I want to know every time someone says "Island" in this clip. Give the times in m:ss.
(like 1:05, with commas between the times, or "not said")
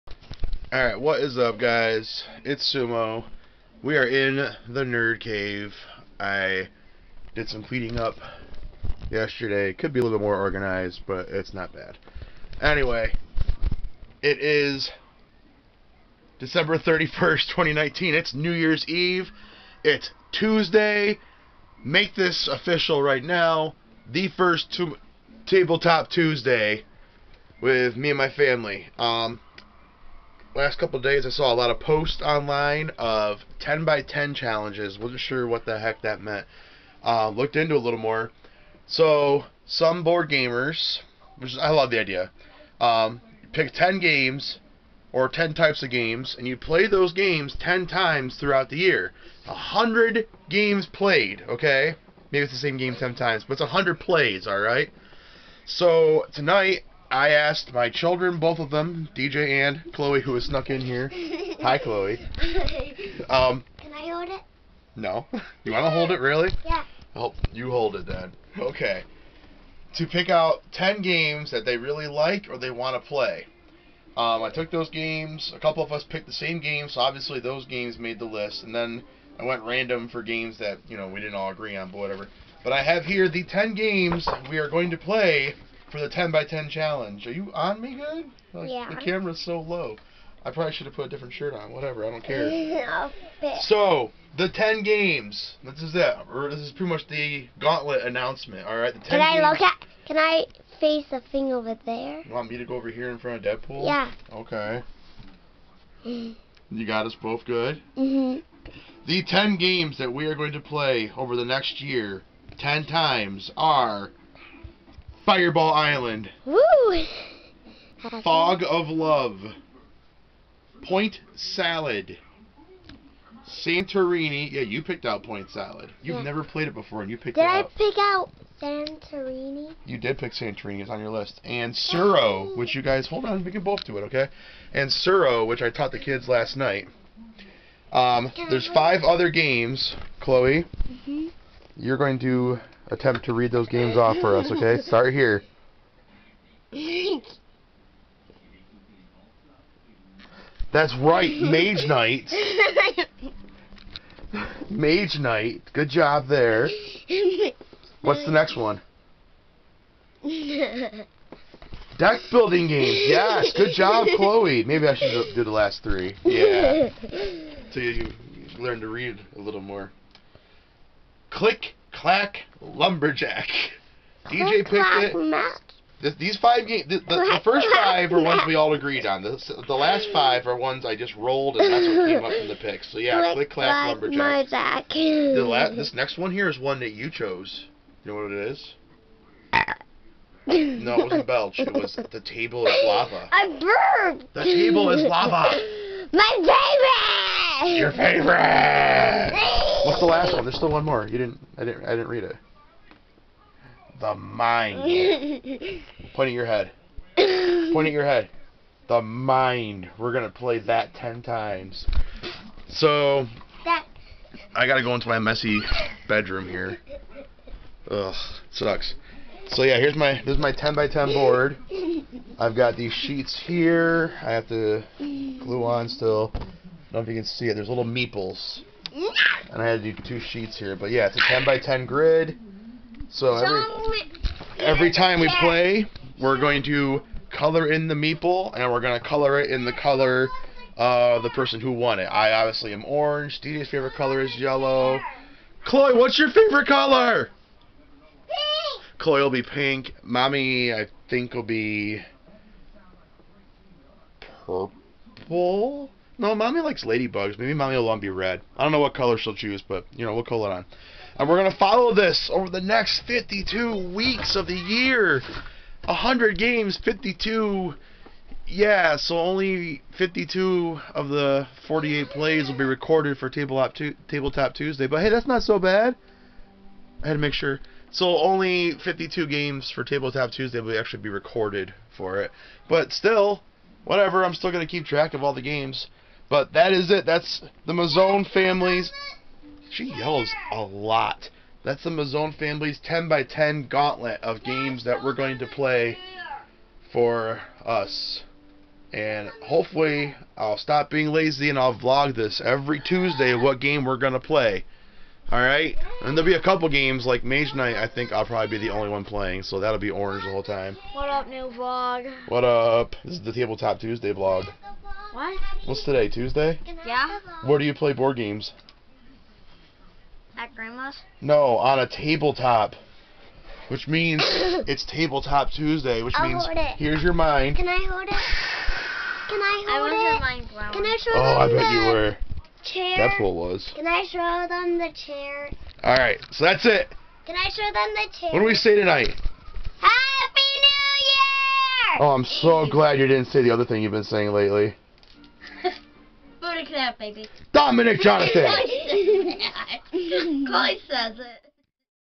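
1:55.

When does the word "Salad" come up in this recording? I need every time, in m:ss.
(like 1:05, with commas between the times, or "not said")
2:01, 2:05.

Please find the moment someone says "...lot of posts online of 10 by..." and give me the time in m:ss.
0:31.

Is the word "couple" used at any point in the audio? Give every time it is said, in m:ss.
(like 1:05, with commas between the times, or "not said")
0:30, 1:15, 5:06.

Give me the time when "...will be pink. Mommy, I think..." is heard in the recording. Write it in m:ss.
4:09.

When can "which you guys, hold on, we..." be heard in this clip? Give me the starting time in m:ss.
2:12.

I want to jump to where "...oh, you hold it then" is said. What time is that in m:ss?
1:07.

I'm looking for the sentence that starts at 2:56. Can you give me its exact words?
This, these five games, the, the, the, first five are ones we all agreed on.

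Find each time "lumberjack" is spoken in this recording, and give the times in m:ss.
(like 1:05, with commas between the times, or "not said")
2:52, 3:04.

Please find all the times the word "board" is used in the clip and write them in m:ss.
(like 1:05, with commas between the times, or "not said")
0:40, 3:41, 5:17.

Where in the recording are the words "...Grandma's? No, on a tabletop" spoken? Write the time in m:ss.
5:20.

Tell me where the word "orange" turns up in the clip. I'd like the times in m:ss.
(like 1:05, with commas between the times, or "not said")
4:02, 5:09.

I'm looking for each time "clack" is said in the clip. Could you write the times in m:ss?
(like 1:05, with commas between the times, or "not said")
2:52, 3:03.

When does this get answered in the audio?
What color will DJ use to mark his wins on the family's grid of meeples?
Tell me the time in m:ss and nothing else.
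4:04.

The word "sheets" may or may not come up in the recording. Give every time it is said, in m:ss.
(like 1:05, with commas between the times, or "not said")
3:42, 3:50.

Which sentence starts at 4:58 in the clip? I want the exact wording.
And hopefully, I'll stop being lazy and I'll vlog this every Tuesday what game we're going to play.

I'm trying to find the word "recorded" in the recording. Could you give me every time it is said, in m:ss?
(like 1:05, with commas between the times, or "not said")
4:32, 4:41.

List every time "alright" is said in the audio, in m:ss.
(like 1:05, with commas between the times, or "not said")
0:00, 0:54, 5:05.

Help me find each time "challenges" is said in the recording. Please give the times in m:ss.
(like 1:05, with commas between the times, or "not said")
0:34, 1:26.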